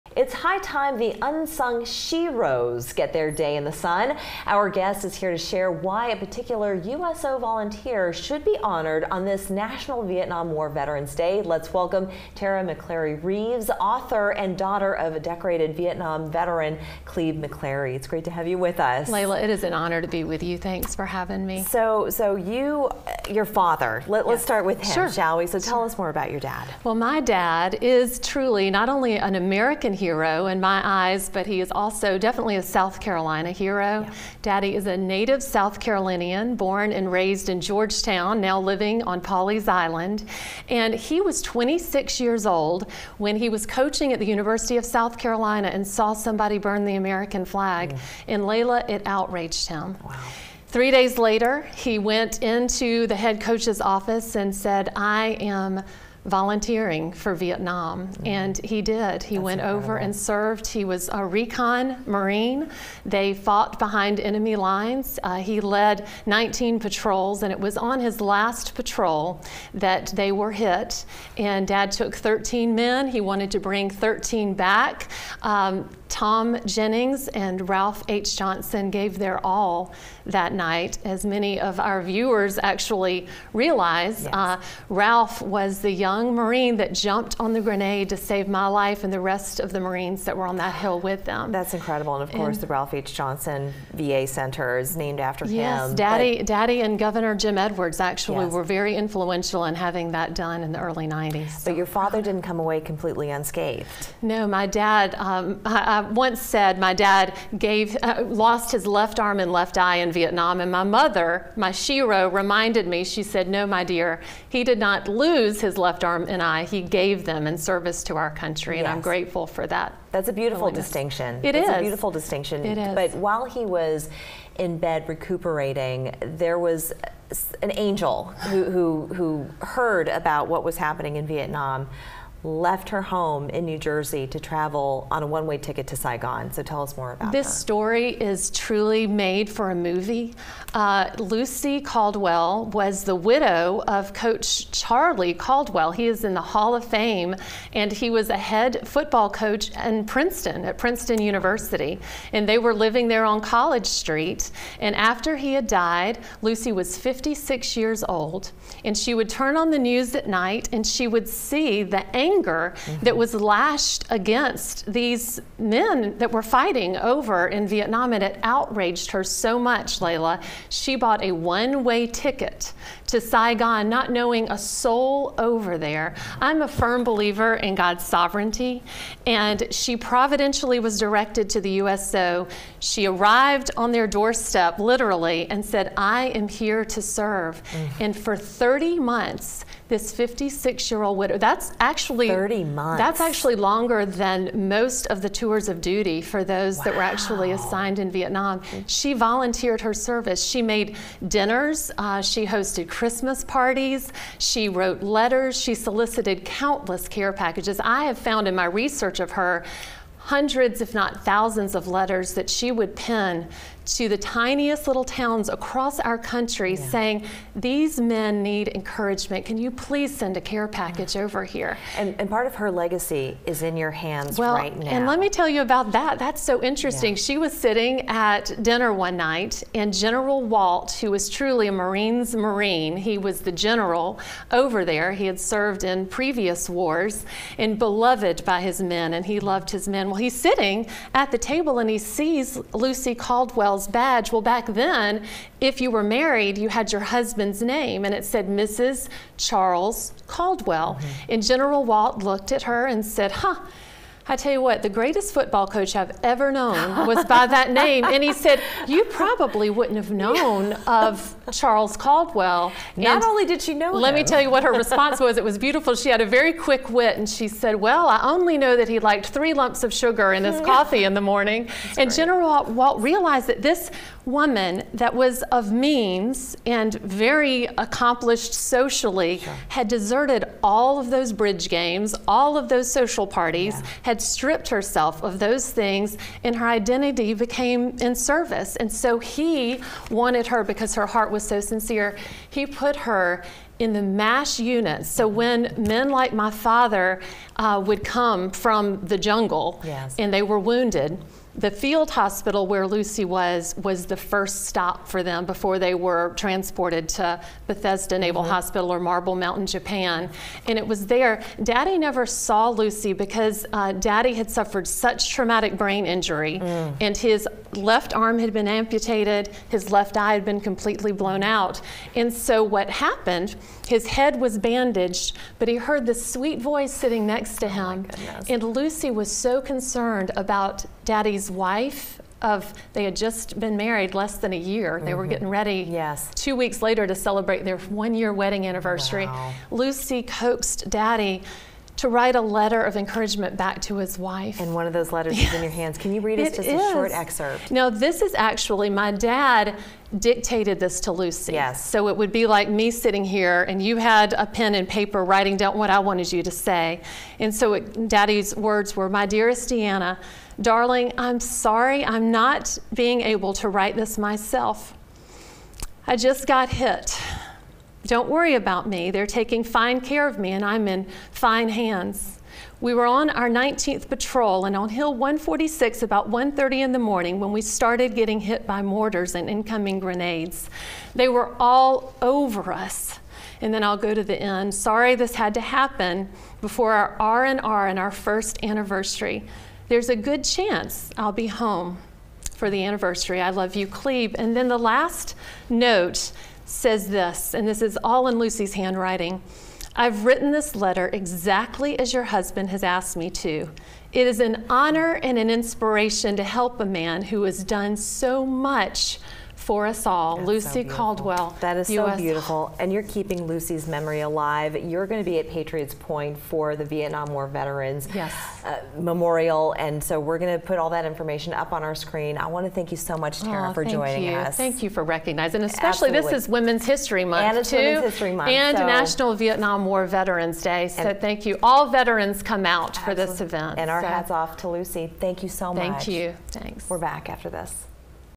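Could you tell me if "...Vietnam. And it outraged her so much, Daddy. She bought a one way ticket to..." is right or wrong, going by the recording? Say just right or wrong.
wrong.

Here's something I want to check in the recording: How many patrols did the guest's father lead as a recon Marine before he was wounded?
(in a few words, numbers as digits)
19.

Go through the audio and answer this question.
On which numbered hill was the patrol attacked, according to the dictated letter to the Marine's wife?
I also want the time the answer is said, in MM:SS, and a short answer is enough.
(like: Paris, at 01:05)
Hill 146, at 06:14.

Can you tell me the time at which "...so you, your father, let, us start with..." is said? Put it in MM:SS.
00:22.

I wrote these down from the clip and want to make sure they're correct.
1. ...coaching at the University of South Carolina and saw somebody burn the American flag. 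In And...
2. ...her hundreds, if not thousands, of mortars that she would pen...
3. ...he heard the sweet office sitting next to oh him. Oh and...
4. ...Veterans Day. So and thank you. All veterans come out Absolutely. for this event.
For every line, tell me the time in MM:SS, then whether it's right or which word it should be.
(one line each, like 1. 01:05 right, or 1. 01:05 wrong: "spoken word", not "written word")
1. 00:43 right
2. 03:29 wrong: "letters", not "mortars"
3. 05:25 wrong: "voice", not "office"
4. 07:10 right.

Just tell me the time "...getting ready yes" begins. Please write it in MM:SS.
05:35.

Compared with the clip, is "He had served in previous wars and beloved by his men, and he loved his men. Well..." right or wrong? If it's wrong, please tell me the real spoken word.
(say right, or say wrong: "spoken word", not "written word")
right.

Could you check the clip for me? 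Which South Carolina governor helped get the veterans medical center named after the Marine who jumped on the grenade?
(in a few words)
Jim Edwards.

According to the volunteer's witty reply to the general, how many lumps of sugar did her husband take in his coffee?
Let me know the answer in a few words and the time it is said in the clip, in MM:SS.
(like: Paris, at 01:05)
3, at 04:29.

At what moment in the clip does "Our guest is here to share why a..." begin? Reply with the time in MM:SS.
00:04.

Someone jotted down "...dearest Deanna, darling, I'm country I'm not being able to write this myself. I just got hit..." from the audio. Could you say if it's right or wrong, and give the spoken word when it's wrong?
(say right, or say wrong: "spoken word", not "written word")
wrong: "sorry", not "country".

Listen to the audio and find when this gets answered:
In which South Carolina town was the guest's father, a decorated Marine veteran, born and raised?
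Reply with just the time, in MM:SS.
00:37.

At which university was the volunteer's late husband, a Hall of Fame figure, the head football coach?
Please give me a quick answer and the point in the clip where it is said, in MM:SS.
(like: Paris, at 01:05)
Princeton University, at 02:30.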